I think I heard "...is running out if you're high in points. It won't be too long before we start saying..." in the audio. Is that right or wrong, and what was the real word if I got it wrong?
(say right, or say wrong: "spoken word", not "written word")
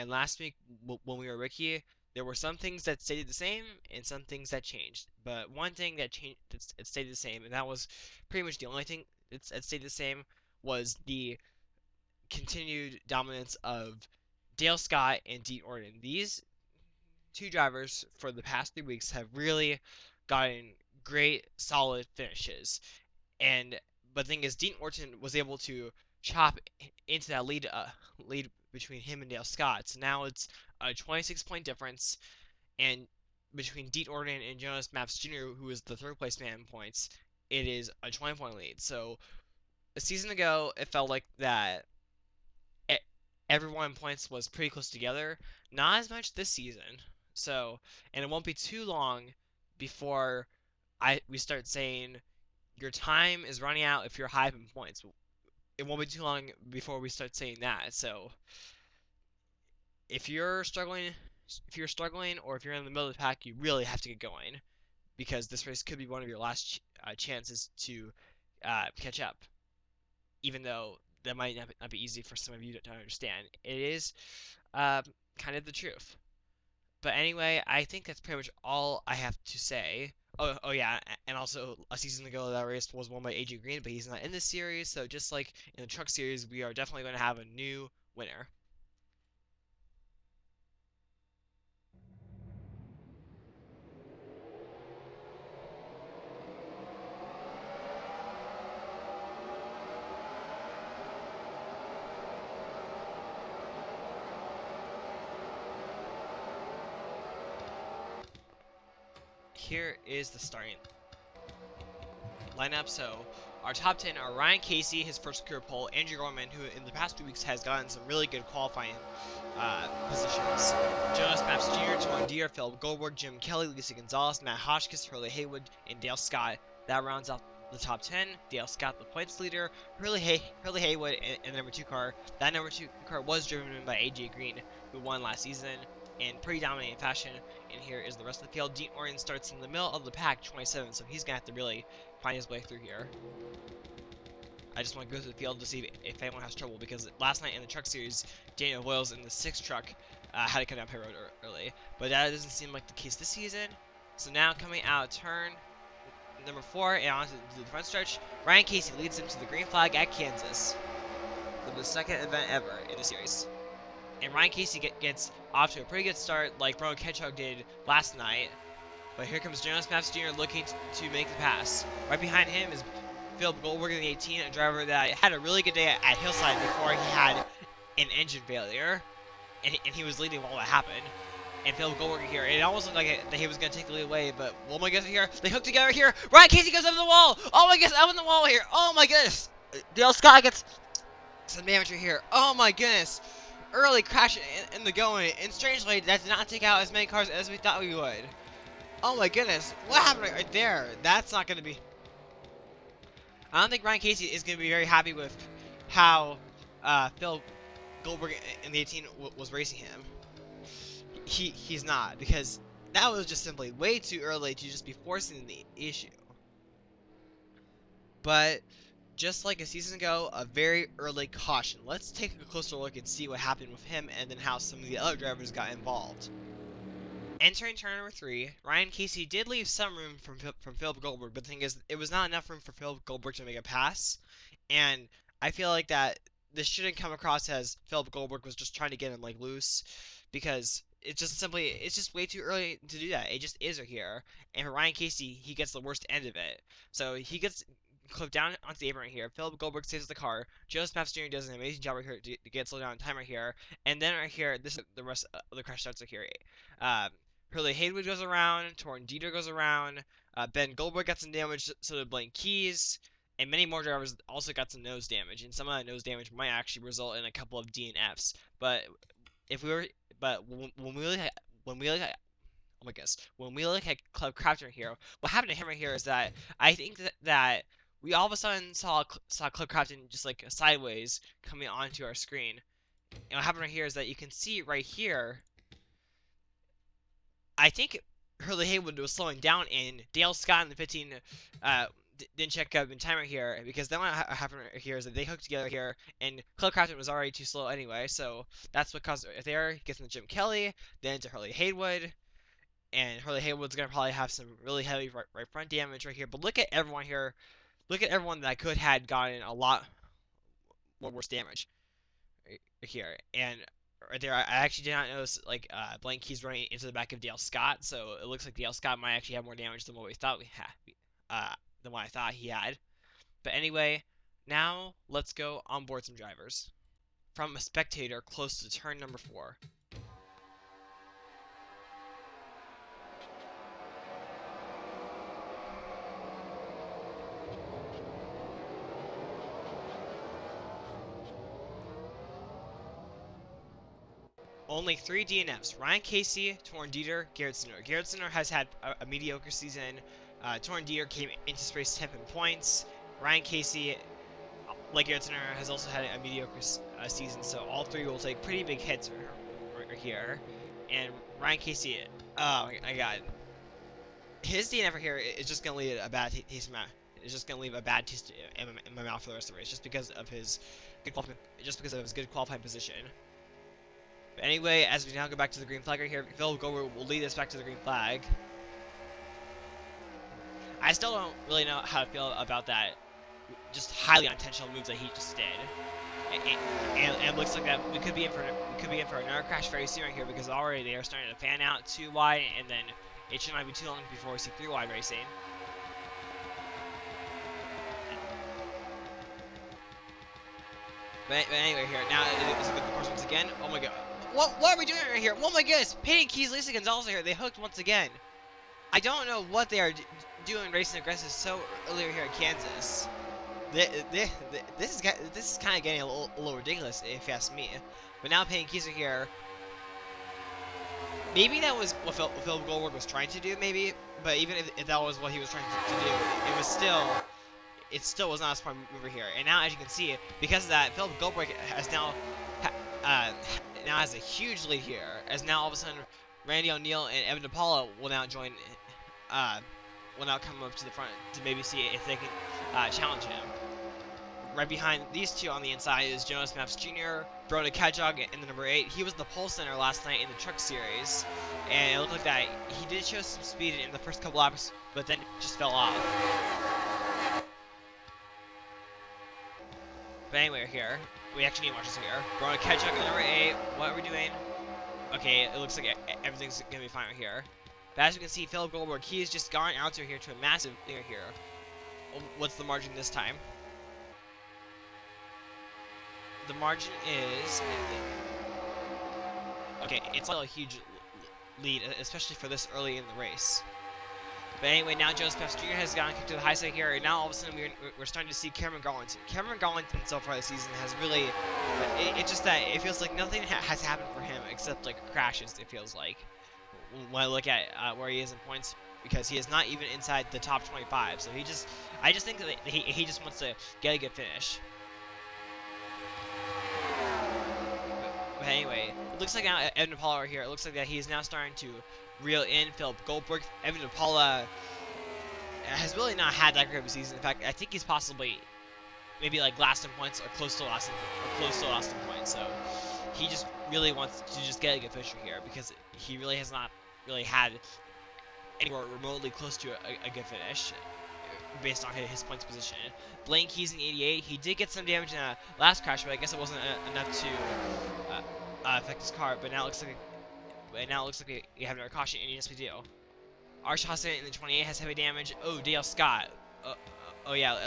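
right.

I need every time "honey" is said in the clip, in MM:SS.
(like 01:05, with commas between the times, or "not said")
not said.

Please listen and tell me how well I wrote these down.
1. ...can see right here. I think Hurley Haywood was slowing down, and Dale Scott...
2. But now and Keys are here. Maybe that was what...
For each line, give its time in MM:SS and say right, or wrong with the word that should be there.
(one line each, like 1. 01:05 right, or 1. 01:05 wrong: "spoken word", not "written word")
1. 04:44 right
2. 06:58 right.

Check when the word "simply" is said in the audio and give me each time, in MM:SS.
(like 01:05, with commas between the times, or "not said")
03:33, 04:01.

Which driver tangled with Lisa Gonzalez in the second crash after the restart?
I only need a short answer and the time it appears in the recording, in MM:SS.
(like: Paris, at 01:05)
Peyton Keys, at 06:46.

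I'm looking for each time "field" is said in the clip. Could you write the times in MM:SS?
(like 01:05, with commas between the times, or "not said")
02:18, 02:25.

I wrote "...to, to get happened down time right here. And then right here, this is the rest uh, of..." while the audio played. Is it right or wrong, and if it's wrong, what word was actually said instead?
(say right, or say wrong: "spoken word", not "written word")
wrong: "slowed", not "happened".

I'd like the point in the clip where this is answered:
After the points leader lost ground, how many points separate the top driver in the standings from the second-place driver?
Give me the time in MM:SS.
00:30.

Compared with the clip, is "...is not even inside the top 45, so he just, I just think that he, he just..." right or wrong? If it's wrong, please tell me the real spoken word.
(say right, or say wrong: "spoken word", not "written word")
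wrong: "25", not "45".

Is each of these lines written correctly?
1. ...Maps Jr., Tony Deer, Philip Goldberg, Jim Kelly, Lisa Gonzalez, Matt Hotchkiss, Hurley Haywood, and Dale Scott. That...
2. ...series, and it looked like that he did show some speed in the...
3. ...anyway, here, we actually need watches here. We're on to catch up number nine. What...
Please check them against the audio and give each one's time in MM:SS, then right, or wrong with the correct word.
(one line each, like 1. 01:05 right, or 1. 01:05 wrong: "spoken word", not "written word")
1. 02:01 right
2. 07:30 right
3. 07:40 wrong: "eight", not "nine".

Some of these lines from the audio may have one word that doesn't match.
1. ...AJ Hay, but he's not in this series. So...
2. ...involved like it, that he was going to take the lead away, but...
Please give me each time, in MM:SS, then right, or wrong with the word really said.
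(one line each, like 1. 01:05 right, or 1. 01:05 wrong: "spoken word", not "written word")
1. 01:23 wrong: "Green", not "Hay"
2. 03:02 wrong: "looked", not "involved".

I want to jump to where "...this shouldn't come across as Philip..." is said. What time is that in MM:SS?
03:56.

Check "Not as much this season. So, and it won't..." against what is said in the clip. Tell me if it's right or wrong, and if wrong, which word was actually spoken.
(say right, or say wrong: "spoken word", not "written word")
right.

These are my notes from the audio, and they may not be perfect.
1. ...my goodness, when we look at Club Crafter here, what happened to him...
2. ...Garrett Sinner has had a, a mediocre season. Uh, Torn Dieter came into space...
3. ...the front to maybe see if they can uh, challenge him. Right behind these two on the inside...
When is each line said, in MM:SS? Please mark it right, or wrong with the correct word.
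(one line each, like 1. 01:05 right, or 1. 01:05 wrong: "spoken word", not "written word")
1. 04:32 right
2. 05:47 right
3. 07:20 right.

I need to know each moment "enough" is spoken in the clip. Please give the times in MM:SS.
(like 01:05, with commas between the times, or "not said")
03:52, 08:56.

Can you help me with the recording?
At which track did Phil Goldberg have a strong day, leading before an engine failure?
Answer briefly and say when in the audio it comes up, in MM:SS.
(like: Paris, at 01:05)
Hillside, at 02:56.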